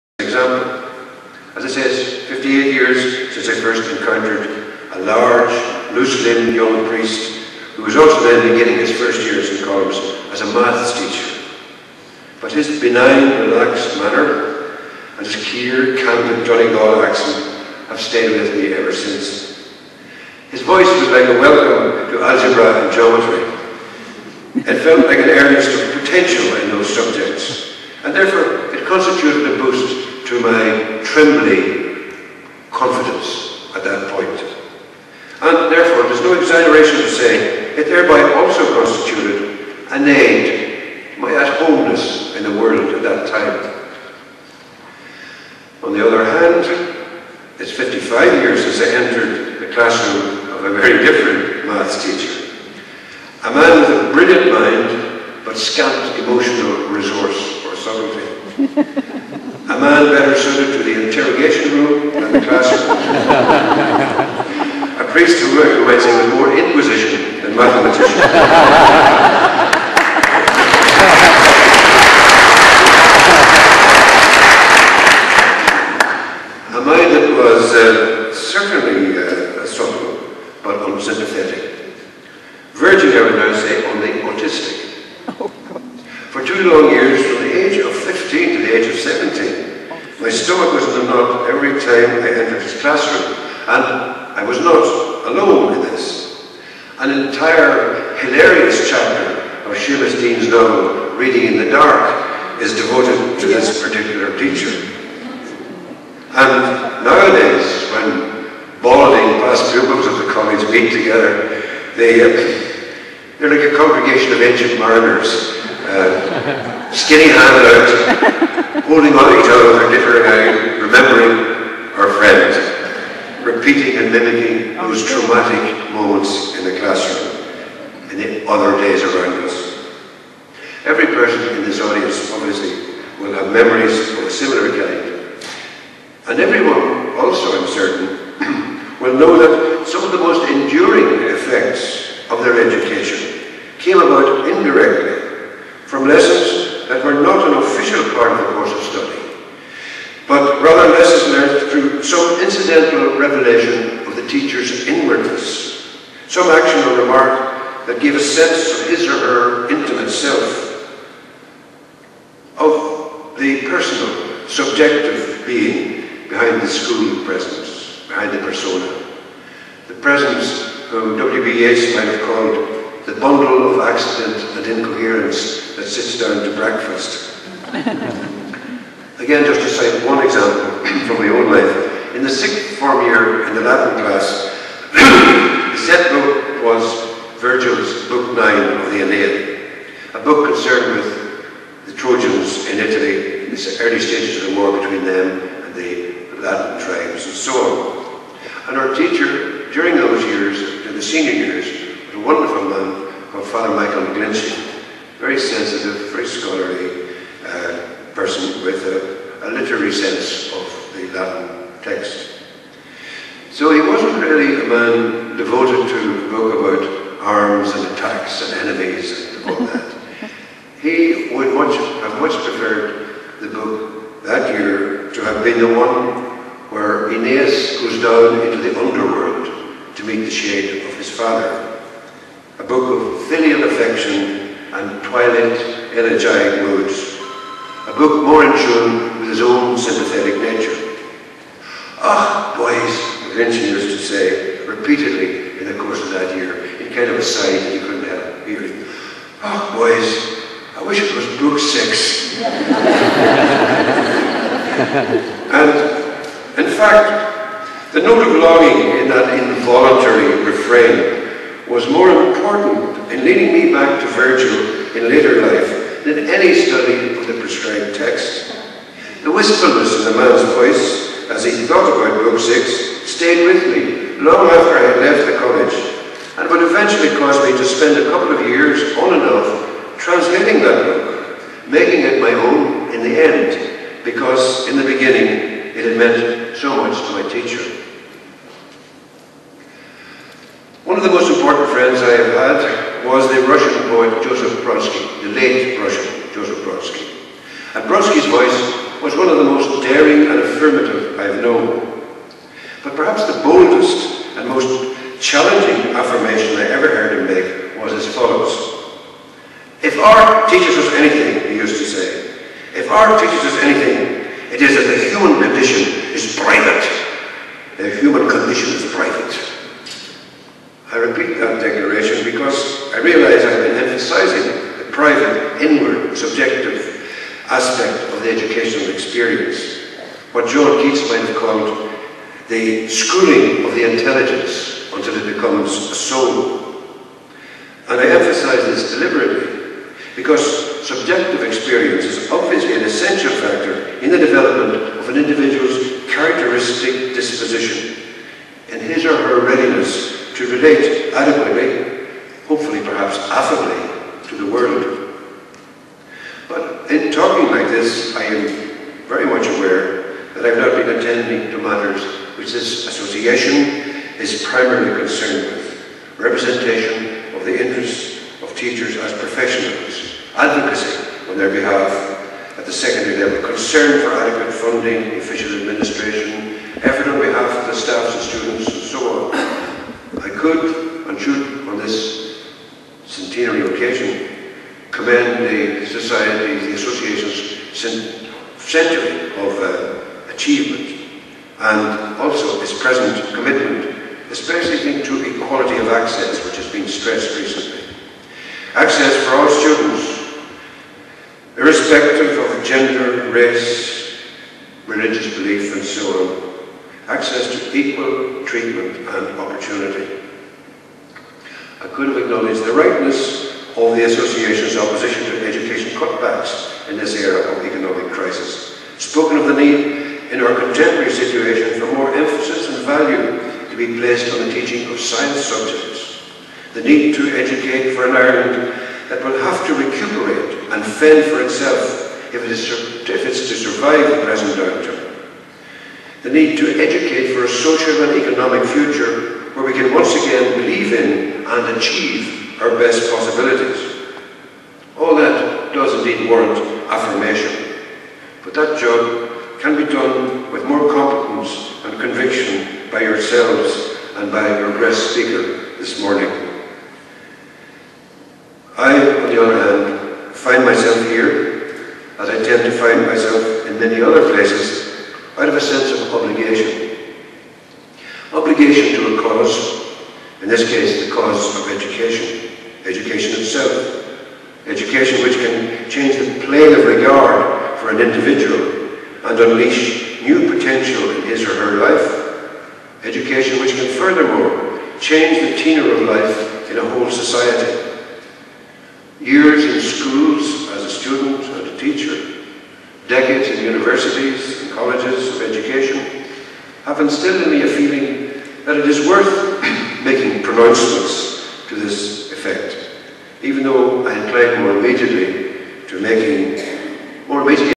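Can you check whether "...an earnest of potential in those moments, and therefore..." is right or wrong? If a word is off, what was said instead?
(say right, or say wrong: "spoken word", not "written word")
wrong: "subjects", not "moments".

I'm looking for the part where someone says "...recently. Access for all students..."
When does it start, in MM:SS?
06:37.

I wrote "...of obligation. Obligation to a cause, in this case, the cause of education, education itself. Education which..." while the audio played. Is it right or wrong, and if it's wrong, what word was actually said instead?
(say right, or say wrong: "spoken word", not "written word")
right.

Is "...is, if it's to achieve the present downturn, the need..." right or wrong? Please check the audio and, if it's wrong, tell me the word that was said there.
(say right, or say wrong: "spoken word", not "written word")
wrong: "survive", not "achieve".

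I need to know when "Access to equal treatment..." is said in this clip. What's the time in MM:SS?
06:47.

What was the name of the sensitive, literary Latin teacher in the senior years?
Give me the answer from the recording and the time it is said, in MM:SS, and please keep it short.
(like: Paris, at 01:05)
Father Michael McGlinchey, at 03:23.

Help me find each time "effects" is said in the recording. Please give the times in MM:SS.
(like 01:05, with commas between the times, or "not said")
02:21, 08:22.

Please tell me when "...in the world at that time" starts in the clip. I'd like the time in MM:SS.
00:42.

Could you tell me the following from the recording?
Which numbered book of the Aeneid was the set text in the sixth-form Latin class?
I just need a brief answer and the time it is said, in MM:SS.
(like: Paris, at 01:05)
Book 9, at 03:08.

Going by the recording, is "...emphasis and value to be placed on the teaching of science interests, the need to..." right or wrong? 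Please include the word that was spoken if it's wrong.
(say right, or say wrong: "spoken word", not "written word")
wrong: "subjects", not "interests".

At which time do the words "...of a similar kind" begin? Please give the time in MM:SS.
02:14.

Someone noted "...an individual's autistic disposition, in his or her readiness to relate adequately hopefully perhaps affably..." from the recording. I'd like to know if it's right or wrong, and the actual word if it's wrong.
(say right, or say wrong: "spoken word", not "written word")
wrong: "characteristic", not "autistic".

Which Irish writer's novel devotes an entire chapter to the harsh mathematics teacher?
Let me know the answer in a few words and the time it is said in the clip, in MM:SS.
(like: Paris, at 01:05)
Seamus Deane, at 01:39.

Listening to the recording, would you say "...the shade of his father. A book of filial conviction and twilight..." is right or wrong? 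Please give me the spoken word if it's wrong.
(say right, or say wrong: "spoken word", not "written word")
wrong: "affection", not "conviction".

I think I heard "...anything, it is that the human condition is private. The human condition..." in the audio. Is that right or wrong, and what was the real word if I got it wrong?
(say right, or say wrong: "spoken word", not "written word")
right.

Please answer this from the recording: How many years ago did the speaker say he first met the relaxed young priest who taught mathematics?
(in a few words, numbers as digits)
58.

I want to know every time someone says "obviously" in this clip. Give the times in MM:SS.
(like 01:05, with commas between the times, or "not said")
02:12, 05:42.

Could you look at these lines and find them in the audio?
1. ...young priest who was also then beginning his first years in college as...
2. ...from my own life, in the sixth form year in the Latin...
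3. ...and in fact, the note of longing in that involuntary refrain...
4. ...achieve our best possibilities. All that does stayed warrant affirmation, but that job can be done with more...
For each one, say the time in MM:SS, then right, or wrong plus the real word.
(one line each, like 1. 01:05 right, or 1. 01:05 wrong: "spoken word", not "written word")
1. 00:06 right
2. 03:01 right
3. 04:12 right
4. 07:21 wrong: "indeed", not "stayed".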